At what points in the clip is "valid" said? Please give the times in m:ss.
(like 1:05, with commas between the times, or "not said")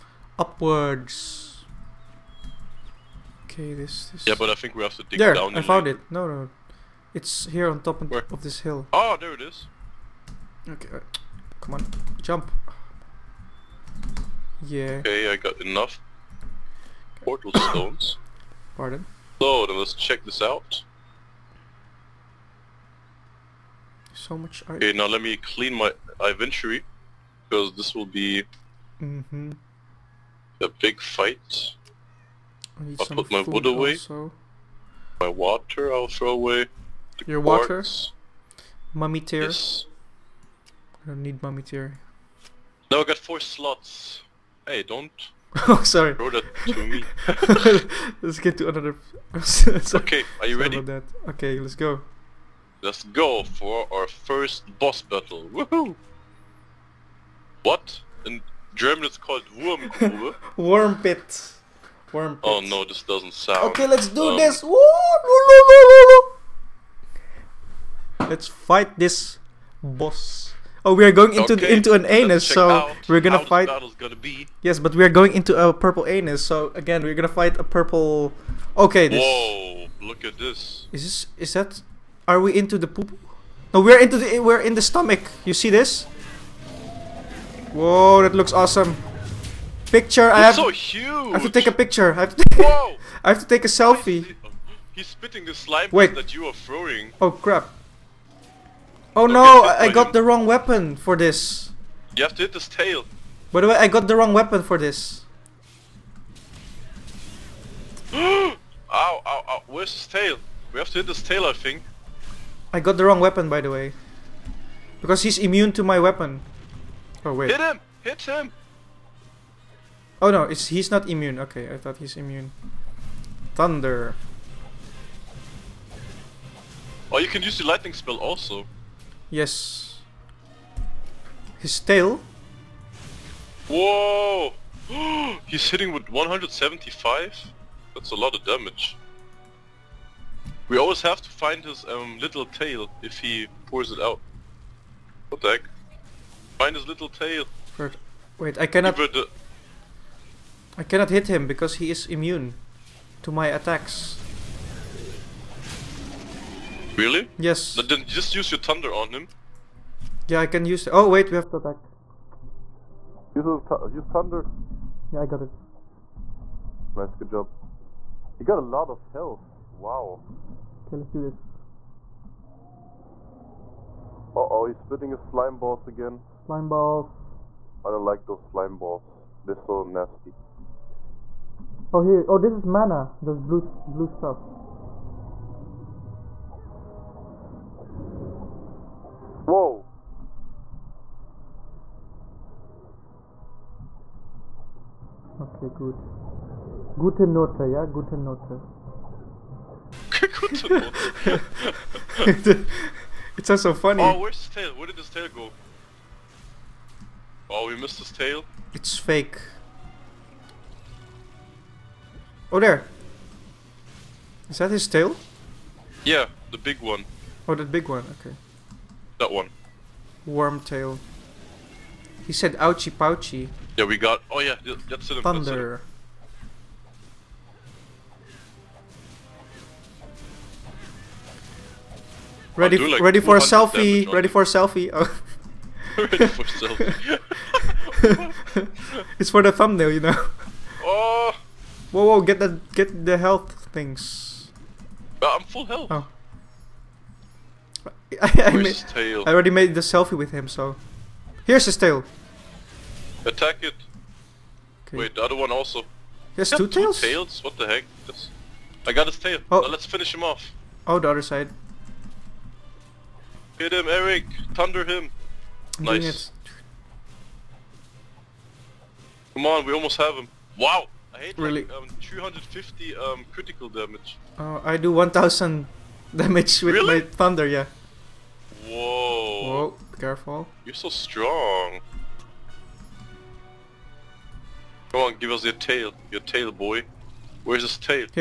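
not said.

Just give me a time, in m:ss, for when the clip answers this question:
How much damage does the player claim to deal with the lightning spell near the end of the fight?
4:34.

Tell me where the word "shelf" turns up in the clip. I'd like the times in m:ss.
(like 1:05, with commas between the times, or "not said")
not said.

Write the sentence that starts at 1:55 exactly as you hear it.
Because he's immune to my weapon.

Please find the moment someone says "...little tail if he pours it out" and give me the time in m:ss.
2:22.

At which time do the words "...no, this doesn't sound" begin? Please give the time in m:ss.
1:02.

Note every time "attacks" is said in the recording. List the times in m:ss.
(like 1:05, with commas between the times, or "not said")
2:33, 2:41, 4:13.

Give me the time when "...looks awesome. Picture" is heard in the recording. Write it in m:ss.
1:28.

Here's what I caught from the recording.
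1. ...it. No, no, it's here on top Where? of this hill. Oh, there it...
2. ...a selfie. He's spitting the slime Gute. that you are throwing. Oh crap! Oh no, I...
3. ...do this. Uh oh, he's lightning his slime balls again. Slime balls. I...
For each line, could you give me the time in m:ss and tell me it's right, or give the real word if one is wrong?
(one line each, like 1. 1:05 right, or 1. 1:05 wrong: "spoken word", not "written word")
1. 0:05 right
2. 1:33 wrong: "Wait", not "Gute"
3. 2:51 wrong: "spitting", not "lightning".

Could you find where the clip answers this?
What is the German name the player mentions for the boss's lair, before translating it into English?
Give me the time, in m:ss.
0:59.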